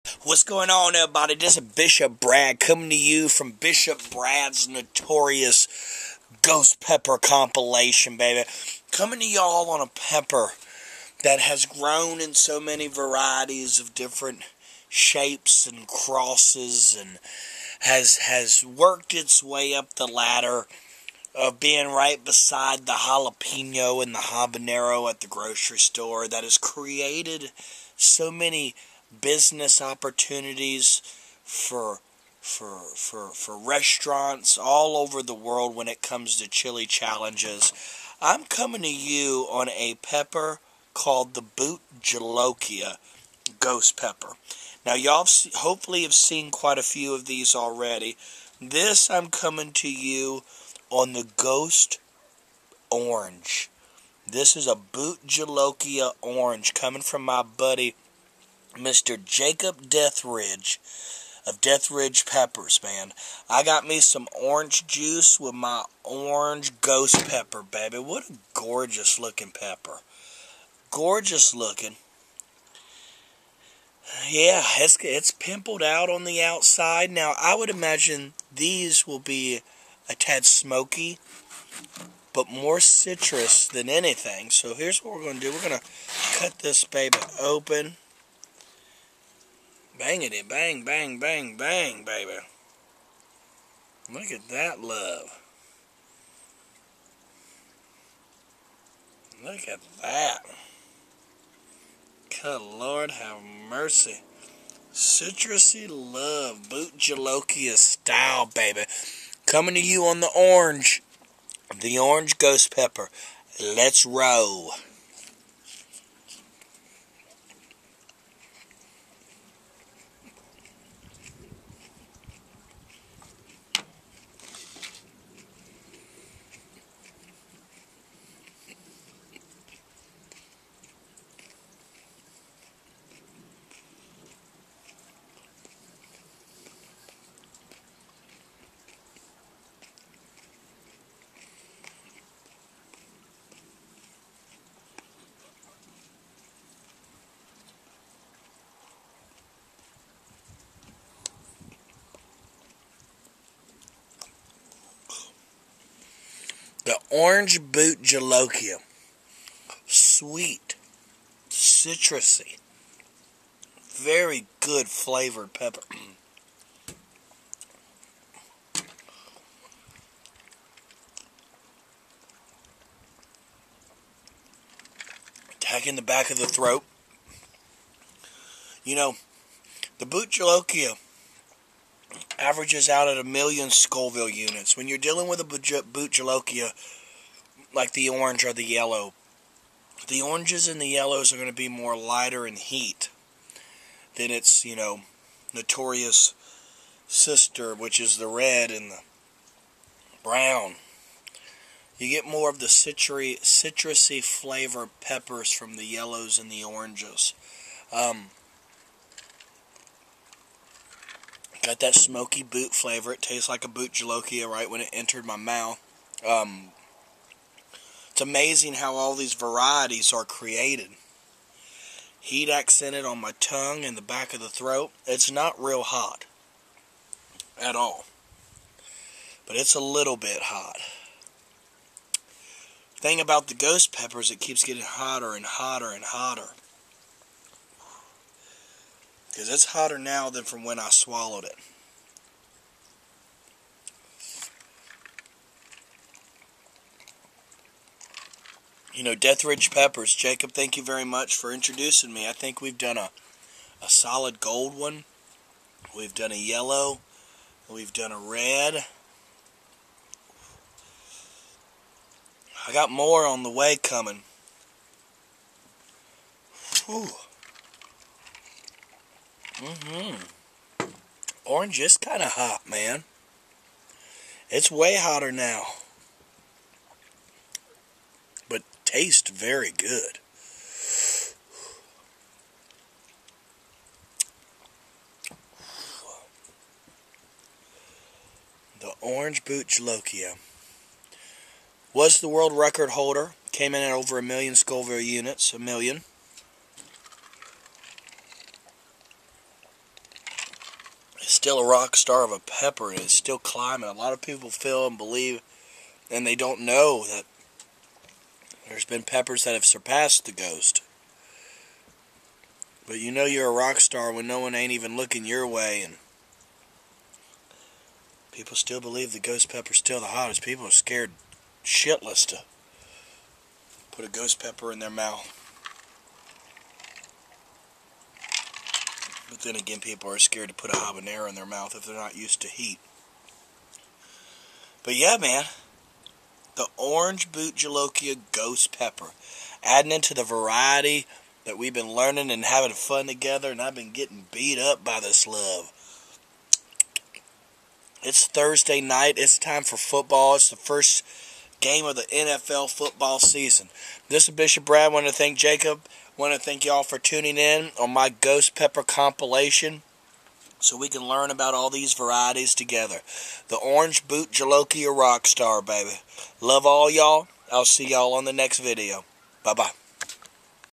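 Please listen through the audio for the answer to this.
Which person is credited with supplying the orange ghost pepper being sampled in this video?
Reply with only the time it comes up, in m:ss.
0:58.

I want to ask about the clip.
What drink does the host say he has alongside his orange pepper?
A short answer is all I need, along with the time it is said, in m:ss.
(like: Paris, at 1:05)
Orange juice, at 1:04.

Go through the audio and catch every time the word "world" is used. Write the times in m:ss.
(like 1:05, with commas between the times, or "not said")
0:35, 4:52.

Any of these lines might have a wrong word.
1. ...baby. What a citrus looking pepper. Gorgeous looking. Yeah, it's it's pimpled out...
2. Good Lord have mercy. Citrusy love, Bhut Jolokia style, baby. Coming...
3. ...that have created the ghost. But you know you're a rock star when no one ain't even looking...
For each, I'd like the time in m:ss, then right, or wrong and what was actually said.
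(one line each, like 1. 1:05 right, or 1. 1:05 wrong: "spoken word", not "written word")
1. 1:07 wrong: "gorgeous", not "citrus"
2. 1:42 right
3. 5:09 wrong: "surpassed", not "created".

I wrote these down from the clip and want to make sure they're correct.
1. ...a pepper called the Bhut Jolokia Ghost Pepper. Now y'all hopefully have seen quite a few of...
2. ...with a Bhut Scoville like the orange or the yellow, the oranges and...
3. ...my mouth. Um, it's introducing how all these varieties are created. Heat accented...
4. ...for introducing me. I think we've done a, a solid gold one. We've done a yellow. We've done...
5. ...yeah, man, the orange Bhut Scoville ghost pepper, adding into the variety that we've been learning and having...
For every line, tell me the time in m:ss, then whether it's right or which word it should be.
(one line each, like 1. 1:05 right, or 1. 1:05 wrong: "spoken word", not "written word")
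1. 0:39 right
2. 3:05 wrong: "Jolokia", not "Scoville"
3. 3:35 wrong: "amazing", not "introducing"
4. 4:11 right
5. 5:34 wrong: "Jolokia", not "Scoville".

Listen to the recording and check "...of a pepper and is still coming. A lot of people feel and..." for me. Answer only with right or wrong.
wrong.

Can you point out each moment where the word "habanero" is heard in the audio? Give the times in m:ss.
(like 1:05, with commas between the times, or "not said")
0:24, 5:30.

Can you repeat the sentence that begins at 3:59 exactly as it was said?
Because it's hotter now than from when I swallowed it.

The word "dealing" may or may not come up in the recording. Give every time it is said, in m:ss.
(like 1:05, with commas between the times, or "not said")
3:04.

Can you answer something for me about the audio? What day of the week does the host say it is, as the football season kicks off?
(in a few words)
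Thursday.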